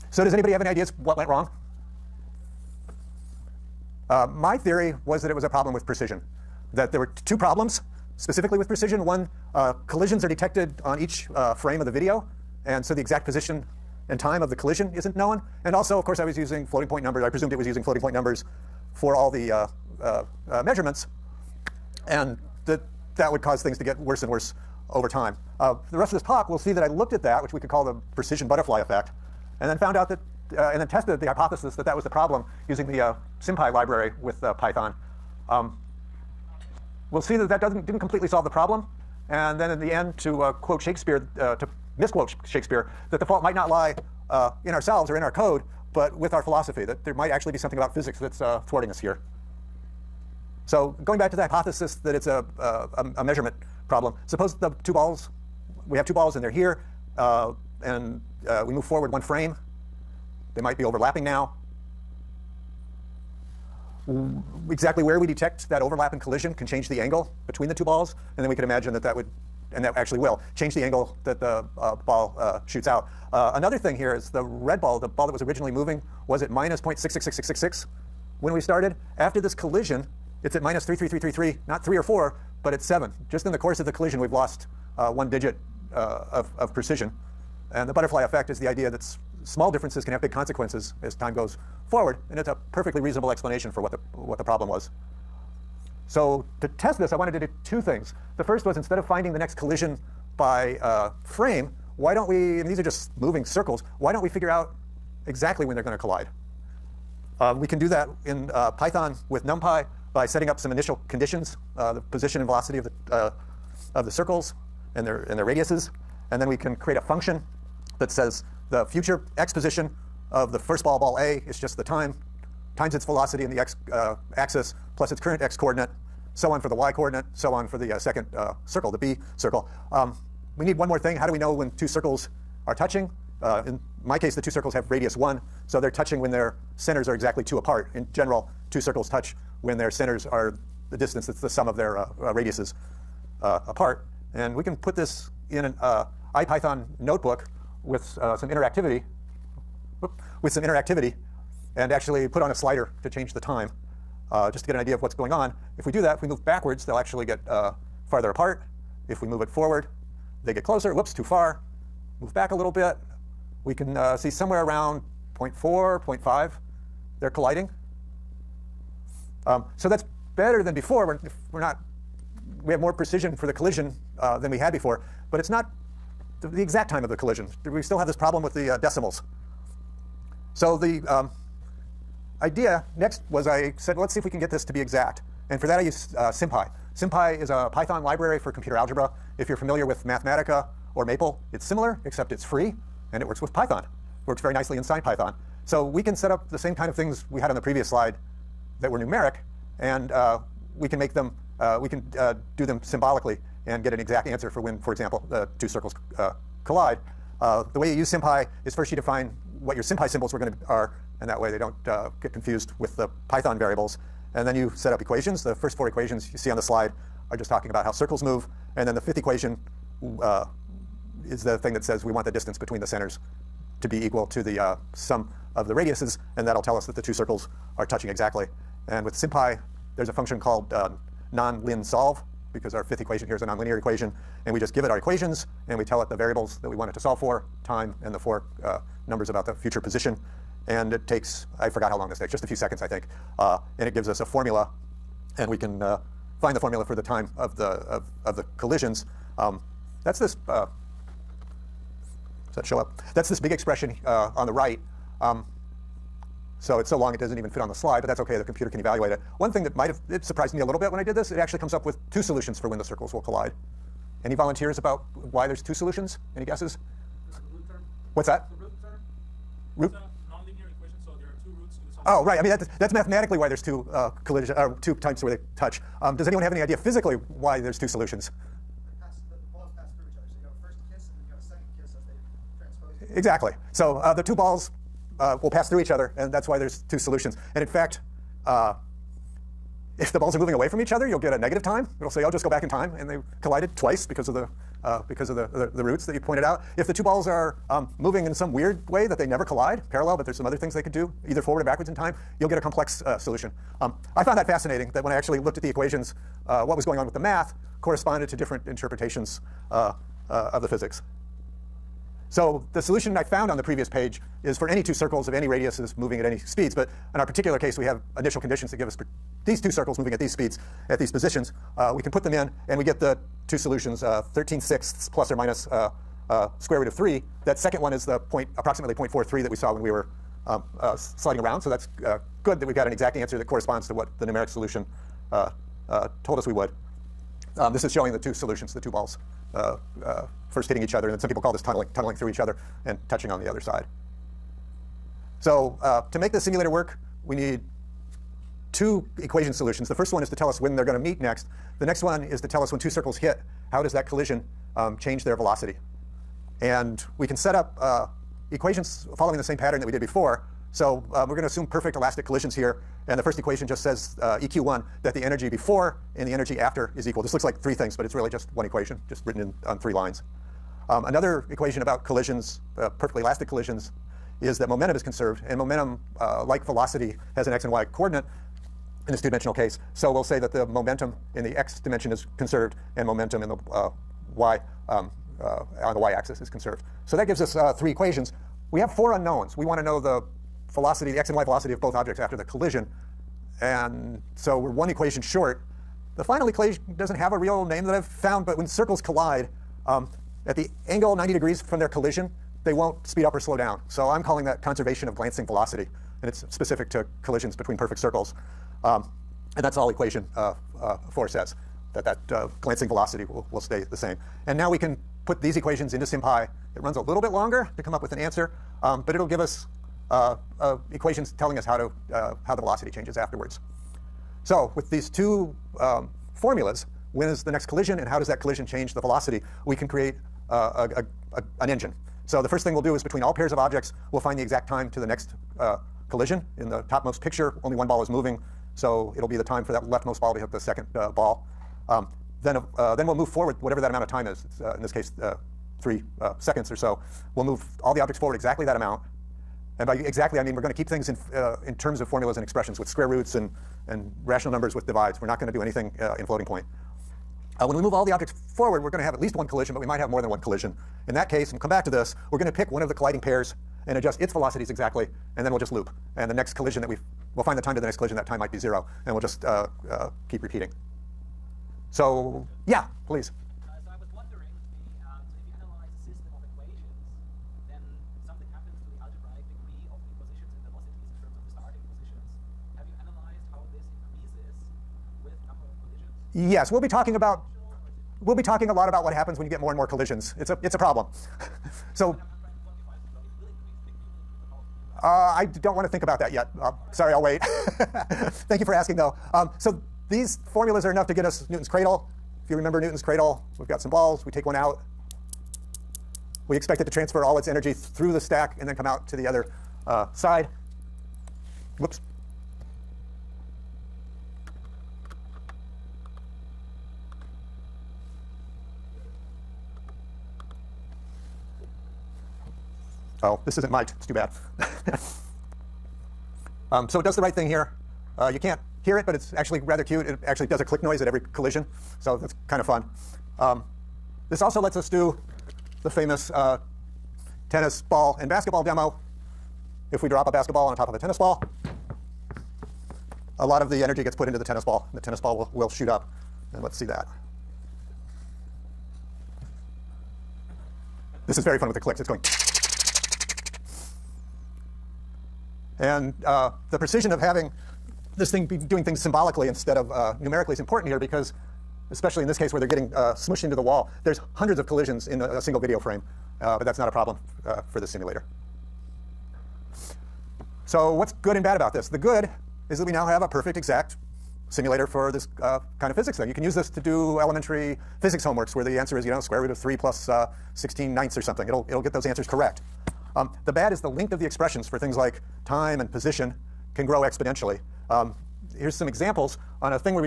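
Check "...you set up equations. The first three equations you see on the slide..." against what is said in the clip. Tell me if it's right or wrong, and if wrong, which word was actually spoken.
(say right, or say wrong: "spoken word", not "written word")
wrong: "four", not "three".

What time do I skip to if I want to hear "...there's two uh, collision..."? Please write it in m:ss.
4:33.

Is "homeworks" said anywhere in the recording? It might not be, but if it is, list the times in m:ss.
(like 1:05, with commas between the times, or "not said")
9:38.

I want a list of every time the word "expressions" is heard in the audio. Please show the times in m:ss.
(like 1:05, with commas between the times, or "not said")
4:13, 7:32, 9:44.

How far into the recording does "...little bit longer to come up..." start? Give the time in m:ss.
6:57.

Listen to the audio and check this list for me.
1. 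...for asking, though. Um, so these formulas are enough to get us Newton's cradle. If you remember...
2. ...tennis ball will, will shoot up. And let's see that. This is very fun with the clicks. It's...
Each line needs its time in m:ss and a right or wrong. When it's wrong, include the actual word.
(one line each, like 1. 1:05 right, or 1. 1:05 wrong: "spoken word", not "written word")
1. 8:18 right
2. 9:04 right.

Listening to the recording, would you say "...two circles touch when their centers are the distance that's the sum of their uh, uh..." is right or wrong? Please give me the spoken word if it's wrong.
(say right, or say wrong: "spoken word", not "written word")
right.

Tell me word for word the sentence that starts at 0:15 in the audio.
And also, of course, I was using floating point numbers.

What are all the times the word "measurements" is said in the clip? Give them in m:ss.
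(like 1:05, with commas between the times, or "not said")
0:20, 0:53.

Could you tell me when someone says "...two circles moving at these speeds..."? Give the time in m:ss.
5:19.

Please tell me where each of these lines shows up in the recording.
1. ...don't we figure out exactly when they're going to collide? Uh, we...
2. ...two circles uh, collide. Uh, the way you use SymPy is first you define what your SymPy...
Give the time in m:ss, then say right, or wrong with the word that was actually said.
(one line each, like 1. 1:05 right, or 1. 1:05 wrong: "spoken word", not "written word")
1. 1:44 right
2. 3:25 right.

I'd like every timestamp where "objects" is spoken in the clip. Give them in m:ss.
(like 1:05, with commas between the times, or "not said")
6:31, 7:13, 7:27, 7:38.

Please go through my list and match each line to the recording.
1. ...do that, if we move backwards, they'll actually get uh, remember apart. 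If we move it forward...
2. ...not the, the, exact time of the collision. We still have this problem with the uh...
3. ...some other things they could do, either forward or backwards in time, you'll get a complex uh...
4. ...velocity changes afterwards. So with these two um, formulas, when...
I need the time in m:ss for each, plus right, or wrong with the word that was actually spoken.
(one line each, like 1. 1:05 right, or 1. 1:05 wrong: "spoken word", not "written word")
1. 2:35 wrong: "farther", not "remember"
2. 2:55 right
3. 5:00 right
4. 7:02 right.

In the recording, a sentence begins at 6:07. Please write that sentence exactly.
This looks like three things, but it's really just one equation, just written in on three lines.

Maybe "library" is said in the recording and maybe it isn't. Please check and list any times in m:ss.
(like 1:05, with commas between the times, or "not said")
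0:33, 3:08.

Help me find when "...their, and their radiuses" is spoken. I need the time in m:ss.
1:55.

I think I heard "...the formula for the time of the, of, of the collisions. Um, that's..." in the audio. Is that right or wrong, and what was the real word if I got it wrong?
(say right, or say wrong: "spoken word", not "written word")
right.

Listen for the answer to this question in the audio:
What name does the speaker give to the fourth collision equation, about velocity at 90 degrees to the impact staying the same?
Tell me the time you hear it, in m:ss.
6:44.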